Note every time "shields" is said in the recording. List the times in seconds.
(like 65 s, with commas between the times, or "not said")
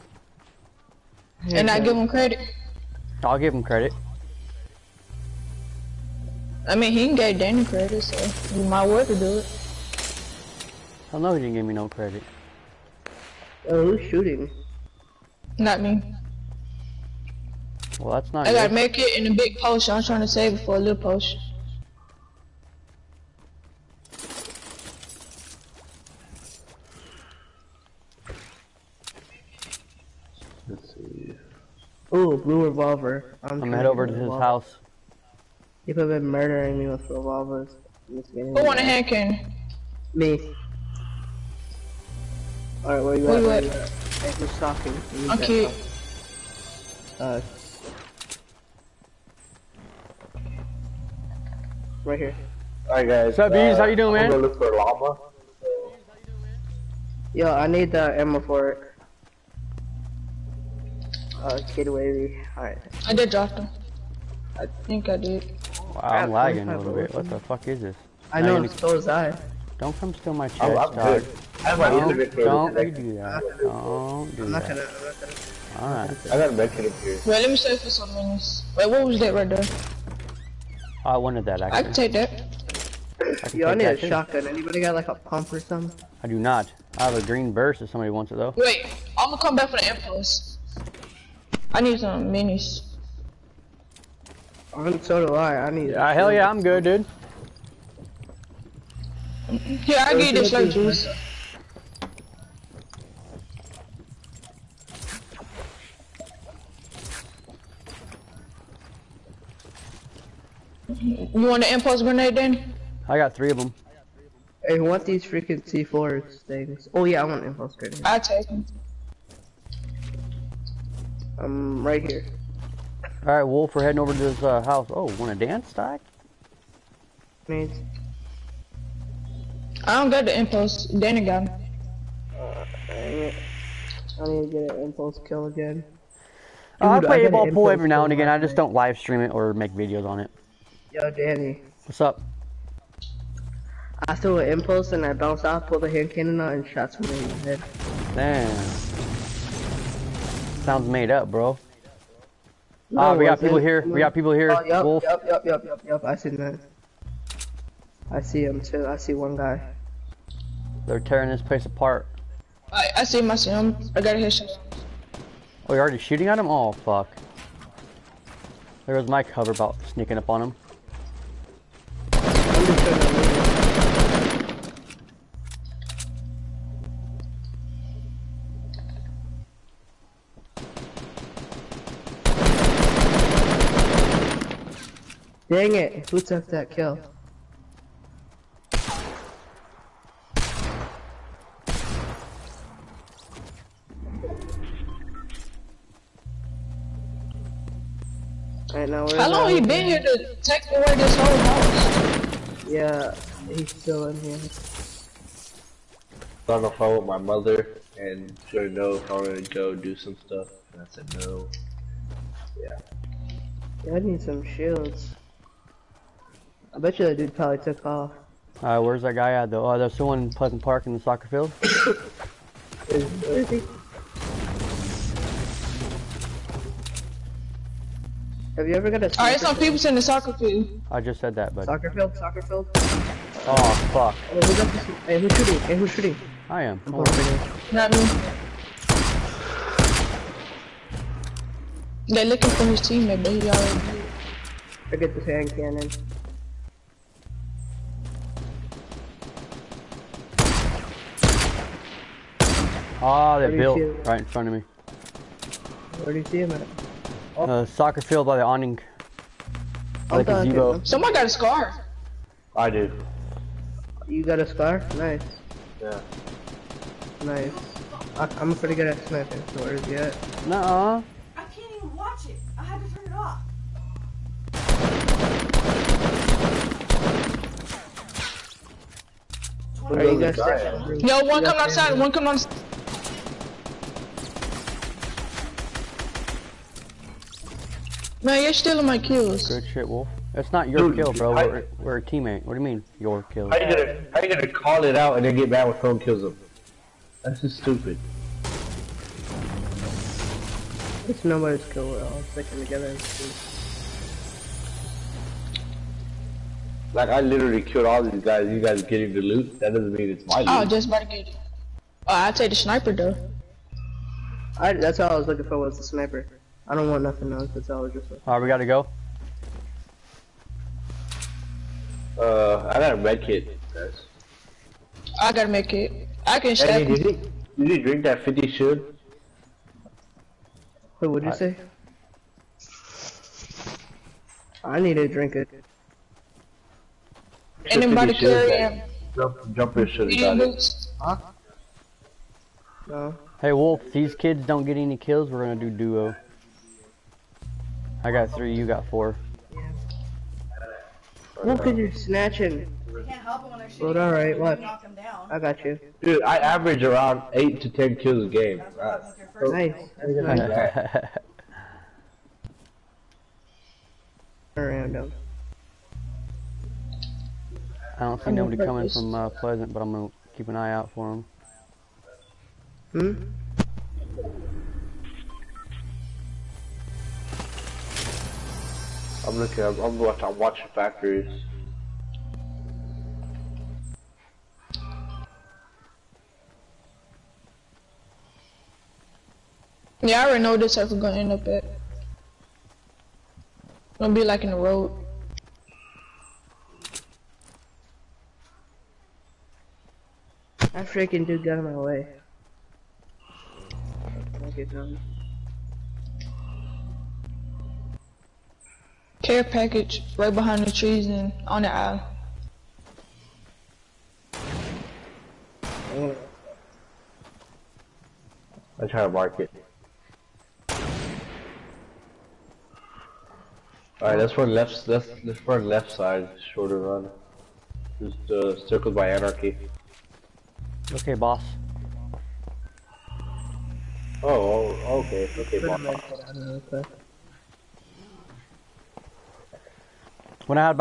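214 s, 328 s.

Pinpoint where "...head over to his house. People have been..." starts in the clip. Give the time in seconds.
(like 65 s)
33 s.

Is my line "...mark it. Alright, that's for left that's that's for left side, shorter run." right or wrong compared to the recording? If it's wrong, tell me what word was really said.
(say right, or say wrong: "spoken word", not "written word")
right.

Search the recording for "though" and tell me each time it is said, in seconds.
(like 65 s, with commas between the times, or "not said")
88 s, 219 s, 312 s.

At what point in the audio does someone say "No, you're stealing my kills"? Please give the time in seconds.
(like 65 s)
288 s.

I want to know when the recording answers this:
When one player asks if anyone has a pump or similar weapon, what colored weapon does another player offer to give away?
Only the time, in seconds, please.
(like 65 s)
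87 s.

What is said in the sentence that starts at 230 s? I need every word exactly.
I just said that, but Soccer field, soccer field.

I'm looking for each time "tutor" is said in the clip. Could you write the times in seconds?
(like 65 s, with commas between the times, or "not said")
not said.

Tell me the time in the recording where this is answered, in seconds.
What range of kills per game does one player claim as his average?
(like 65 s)
357 s.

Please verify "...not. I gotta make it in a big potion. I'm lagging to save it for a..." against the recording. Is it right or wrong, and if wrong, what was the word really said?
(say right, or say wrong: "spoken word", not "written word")
wrong: "trying", not "lagging".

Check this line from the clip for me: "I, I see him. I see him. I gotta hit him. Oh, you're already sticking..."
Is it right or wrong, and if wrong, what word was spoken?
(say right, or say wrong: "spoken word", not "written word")
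wrong: "shooting", not "sticking".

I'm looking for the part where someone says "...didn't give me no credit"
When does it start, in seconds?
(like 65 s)
11 s.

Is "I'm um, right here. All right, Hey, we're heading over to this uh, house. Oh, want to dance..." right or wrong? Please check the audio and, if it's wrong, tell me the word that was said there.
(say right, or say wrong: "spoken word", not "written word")
wrong: "Wolf", not "Hey".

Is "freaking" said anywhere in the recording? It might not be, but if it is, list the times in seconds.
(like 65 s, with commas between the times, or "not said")
115 s, 400 s.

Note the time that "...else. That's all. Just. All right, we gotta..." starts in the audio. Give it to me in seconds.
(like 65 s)
317 s.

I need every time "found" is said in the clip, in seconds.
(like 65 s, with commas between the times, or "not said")
not said.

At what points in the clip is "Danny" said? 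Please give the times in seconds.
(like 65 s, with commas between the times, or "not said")
7 s, 130 s, 141 s.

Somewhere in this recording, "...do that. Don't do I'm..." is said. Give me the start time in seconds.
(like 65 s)
72 s.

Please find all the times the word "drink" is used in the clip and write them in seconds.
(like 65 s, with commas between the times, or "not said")
327 s, 335 s.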